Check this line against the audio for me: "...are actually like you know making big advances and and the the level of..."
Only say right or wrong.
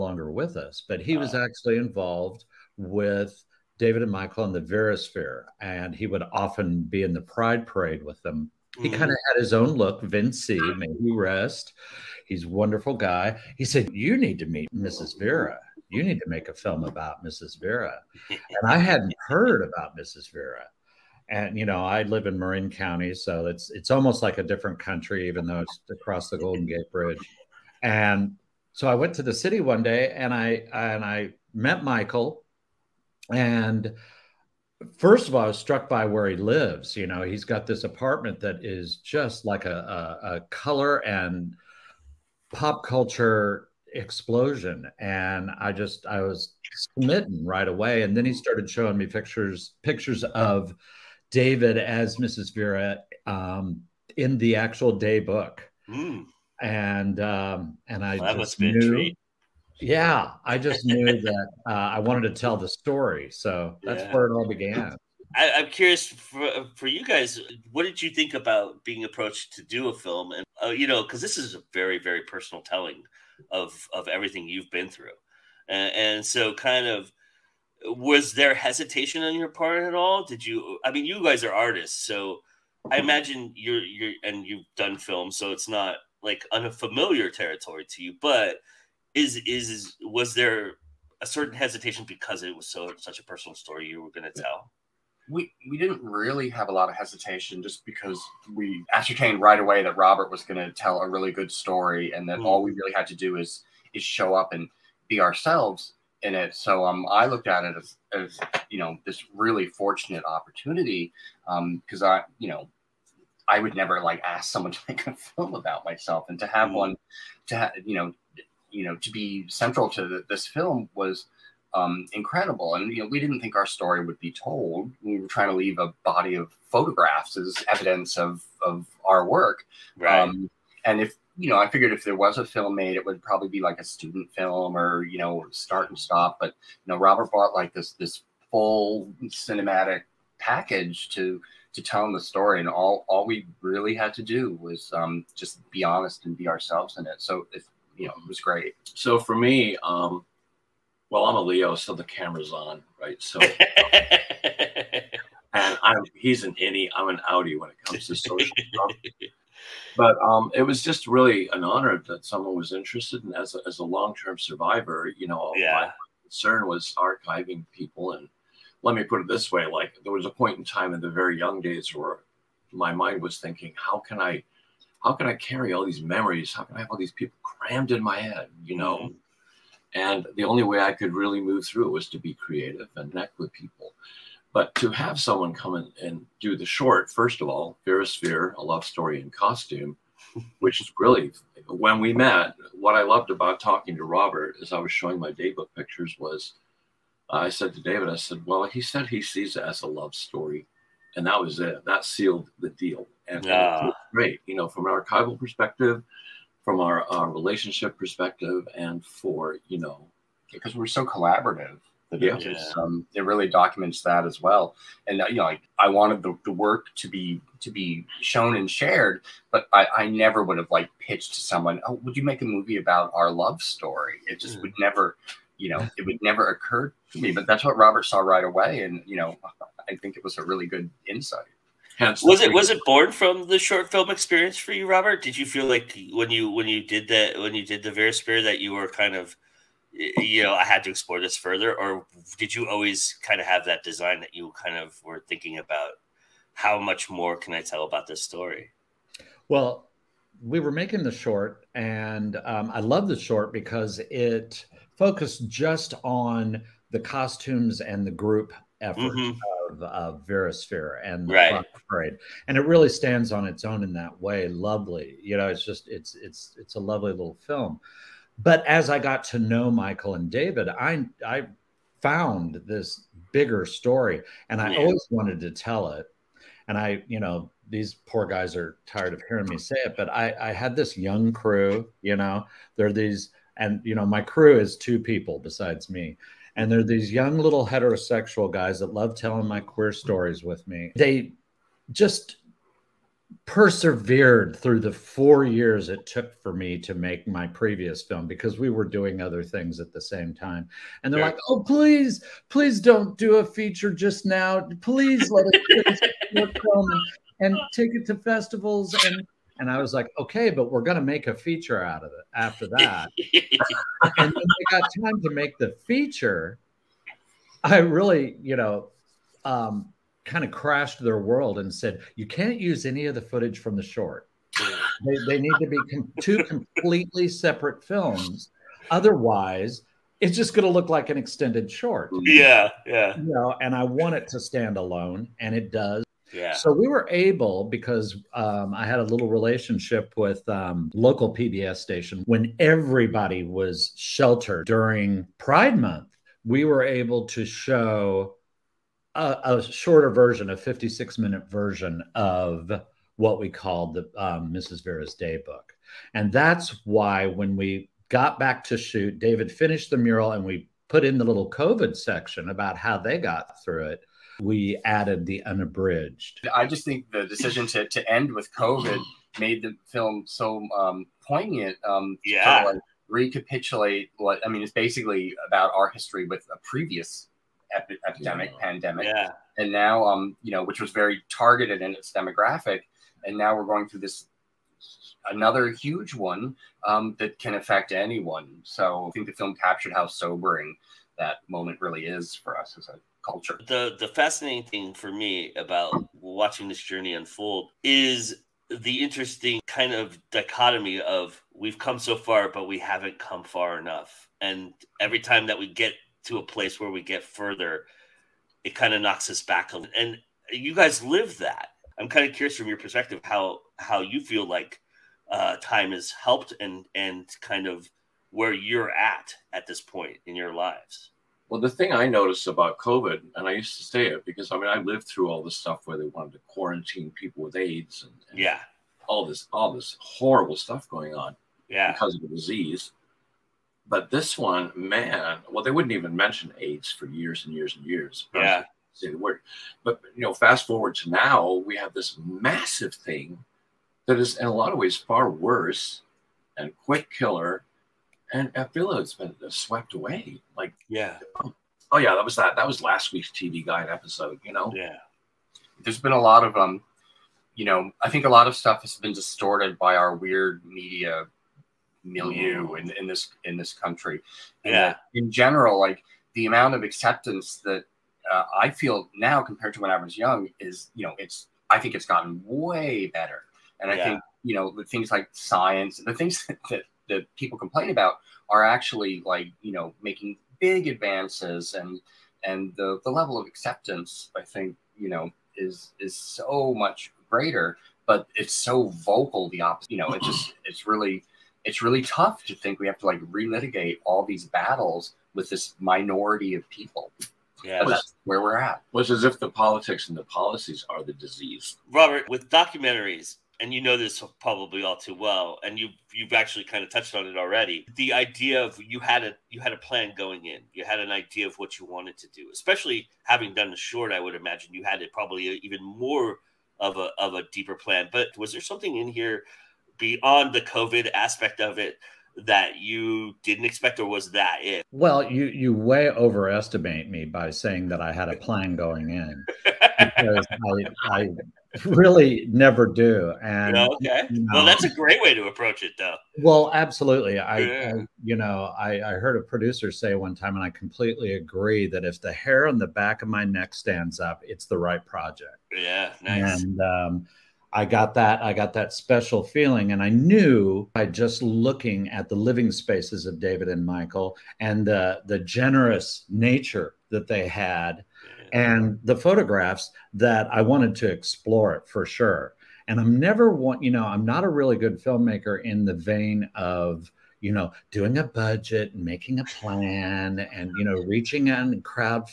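right.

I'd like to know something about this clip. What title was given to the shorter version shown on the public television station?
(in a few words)
Mrs. Vera's Daybook.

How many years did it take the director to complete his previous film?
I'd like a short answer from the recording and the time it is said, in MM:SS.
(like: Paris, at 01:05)
4, at 04:54.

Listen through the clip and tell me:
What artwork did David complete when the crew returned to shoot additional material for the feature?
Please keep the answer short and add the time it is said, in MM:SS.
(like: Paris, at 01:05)
the mural, at 05:59.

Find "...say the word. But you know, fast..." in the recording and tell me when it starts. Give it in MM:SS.
07:18.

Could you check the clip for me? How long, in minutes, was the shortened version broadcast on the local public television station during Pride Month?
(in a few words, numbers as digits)
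56.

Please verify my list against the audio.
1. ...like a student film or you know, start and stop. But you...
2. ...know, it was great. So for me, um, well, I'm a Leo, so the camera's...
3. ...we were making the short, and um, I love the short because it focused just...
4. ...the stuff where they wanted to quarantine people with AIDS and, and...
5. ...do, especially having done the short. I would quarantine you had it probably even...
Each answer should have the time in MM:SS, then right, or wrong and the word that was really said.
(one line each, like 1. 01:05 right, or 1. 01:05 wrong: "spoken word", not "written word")
1. 02:13 right
2. 02:28 right
3. 04:10 right
4. 07:05 right
5. 08:32 wrong: "imagine", not "quarantine".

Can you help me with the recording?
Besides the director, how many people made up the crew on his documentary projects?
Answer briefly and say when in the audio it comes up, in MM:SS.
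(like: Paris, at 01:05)
2, at 04:44.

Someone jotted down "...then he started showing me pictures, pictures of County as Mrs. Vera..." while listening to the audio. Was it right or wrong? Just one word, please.
wrong.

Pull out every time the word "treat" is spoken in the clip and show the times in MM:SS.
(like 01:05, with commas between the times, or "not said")
00:58.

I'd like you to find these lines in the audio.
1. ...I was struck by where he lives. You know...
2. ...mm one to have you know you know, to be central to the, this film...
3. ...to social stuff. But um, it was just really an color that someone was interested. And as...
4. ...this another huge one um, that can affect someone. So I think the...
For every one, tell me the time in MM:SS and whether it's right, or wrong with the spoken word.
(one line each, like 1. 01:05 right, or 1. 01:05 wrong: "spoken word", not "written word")
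1. 00:35 right
2. 01:56 right
3. 02:38 wrong: "honor", not "color"
4. 06:24 wrong: "anyone", not "someone".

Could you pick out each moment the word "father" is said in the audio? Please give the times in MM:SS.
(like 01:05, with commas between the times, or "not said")
not said.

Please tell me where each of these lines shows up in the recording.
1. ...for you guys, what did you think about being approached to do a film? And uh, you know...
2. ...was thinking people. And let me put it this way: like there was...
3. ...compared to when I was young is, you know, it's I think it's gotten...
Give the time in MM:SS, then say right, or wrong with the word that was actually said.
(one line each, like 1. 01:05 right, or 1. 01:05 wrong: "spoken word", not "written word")
1. 01:06 right
2. 02:46 wrong: "archiving", not "thinking"
3. 07:49 right.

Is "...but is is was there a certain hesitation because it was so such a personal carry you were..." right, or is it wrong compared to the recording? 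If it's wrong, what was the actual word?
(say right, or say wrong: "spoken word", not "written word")
wrong: "story", not "carry".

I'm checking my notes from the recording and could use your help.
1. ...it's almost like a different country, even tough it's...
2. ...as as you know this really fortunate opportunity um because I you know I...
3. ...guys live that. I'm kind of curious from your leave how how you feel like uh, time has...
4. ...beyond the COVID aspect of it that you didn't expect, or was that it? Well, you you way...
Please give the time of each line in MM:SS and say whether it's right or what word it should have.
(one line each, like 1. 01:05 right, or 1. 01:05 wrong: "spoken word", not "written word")
1. 00:23 wrong: "though", not "tough"
2. 01:47 right
3. 06:50 wrong: "perspective", not "leave"
4. 08:39 right.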